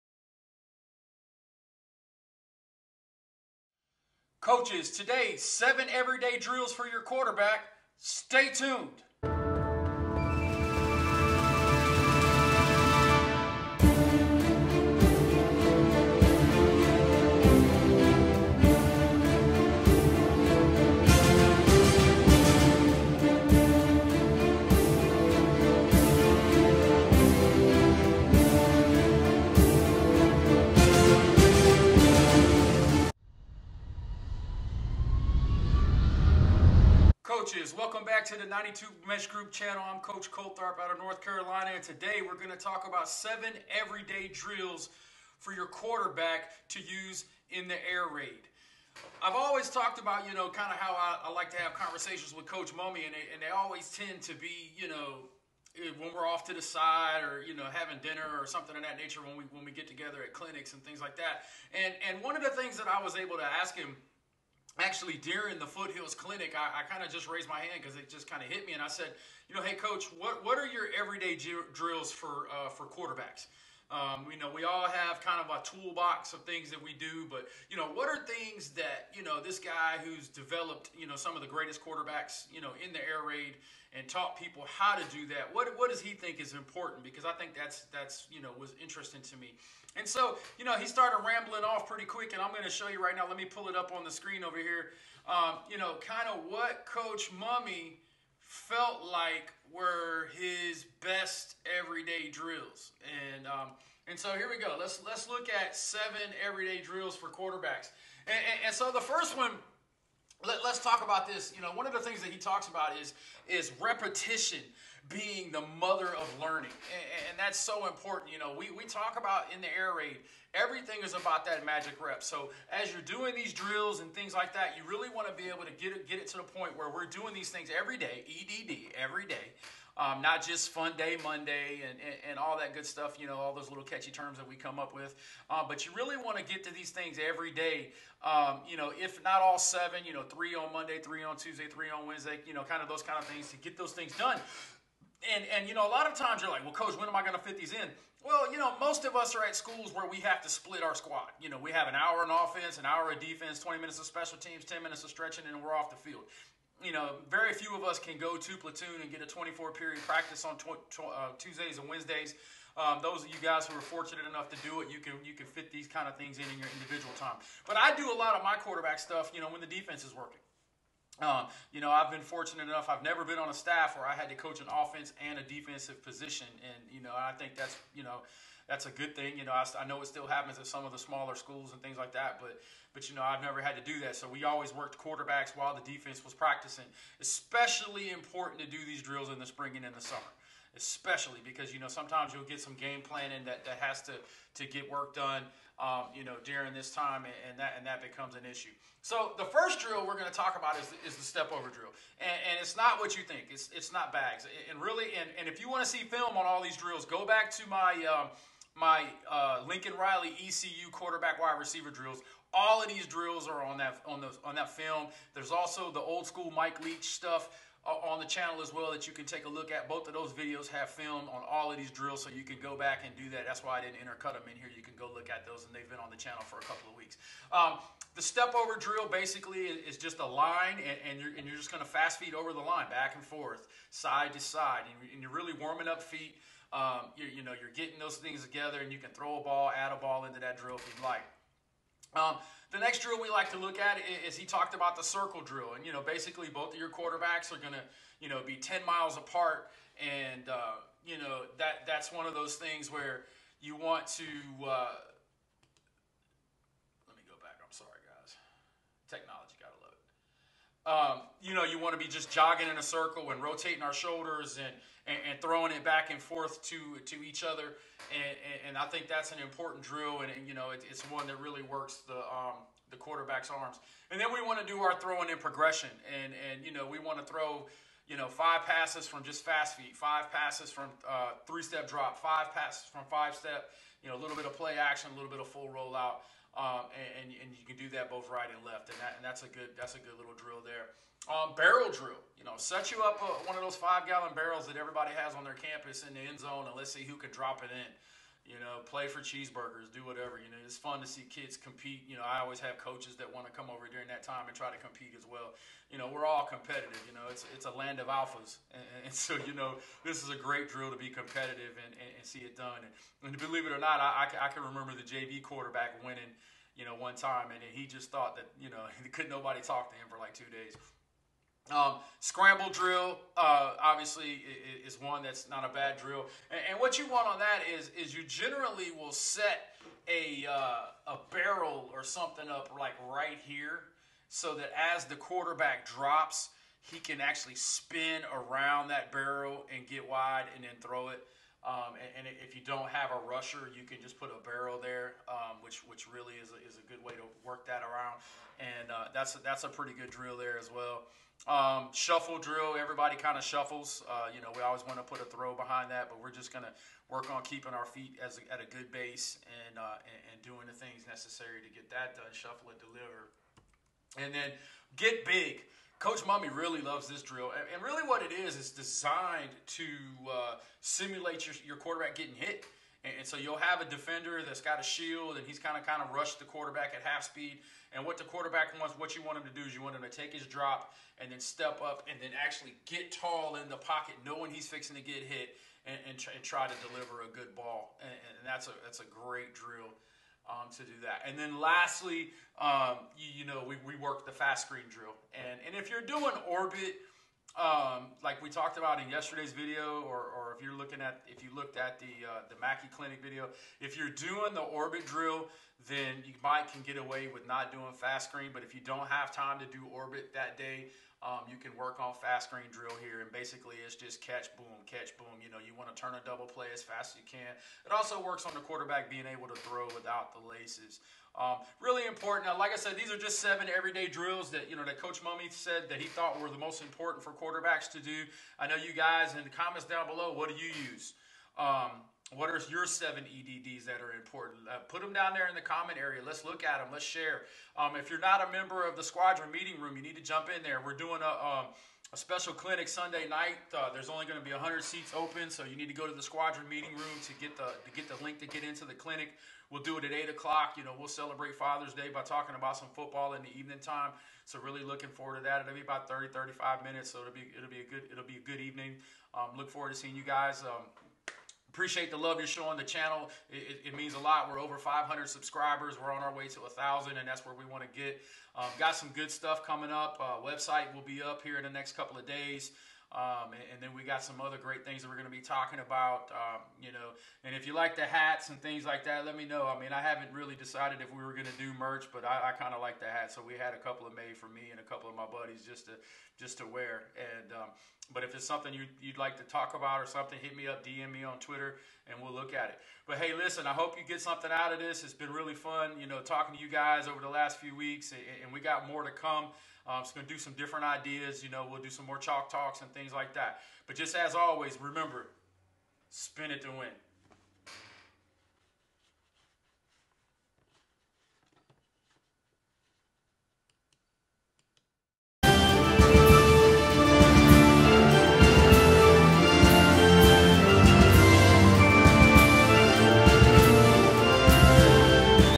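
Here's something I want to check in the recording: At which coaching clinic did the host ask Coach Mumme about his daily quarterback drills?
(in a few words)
Foothills clinic.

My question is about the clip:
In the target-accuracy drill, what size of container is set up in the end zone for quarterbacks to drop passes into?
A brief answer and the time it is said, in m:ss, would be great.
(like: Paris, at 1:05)
5 gallon, at 4:53.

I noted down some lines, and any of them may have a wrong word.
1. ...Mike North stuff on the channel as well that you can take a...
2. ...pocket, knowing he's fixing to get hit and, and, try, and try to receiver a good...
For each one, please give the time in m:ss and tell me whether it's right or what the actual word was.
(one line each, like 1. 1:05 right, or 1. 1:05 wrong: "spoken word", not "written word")
1. 3:36 wrong: "Leach", not "North"
2. 6:23 wrong: "deliver", not "receiver".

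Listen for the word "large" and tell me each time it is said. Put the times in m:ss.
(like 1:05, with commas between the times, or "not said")
not said.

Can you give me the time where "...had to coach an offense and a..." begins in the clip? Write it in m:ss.
2:54.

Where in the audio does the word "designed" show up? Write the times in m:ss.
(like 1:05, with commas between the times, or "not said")
6:08.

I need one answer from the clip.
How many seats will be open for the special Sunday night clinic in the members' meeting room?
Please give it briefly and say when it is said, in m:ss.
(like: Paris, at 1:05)
100, at 7:24.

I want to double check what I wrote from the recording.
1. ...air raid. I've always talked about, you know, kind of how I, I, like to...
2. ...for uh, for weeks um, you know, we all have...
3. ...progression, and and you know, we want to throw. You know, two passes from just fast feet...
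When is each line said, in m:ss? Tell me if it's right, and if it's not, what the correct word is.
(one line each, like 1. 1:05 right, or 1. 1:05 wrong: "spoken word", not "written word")
1. 0:47 right
2. 1:12 wrong: "quarterbacks", not "weeks"
3. 4:35 wrong: "five", not "two".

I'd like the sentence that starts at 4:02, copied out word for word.
Um, the next drill we like to look at is he talked about the circle drill.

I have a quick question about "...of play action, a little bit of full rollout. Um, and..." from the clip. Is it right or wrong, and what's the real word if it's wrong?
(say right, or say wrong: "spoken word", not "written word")
right.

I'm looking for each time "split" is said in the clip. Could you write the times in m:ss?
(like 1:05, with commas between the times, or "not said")
2:30.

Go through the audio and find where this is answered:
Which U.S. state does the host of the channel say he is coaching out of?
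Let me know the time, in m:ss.
0:40.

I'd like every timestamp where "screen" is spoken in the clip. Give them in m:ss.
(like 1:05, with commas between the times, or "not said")
1:34, 6:34, 6:48, 6:52.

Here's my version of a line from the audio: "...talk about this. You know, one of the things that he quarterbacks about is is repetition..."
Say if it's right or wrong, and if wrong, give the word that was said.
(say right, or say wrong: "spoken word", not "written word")
wrong: "talks", not "quarterbacks".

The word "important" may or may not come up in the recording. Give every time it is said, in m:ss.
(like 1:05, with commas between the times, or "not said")
1:26, 1:57, 3:08, 4:29, 7:02, 7:06, 7:14.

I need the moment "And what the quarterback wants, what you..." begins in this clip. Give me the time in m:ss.
6:17.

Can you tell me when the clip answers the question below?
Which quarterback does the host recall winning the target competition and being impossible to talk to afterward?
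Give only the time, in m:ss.
5:15.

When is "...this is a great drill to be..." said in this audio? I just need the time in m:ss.
5:10.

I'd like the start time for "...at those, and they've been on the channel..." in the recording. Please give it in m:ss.
3:45.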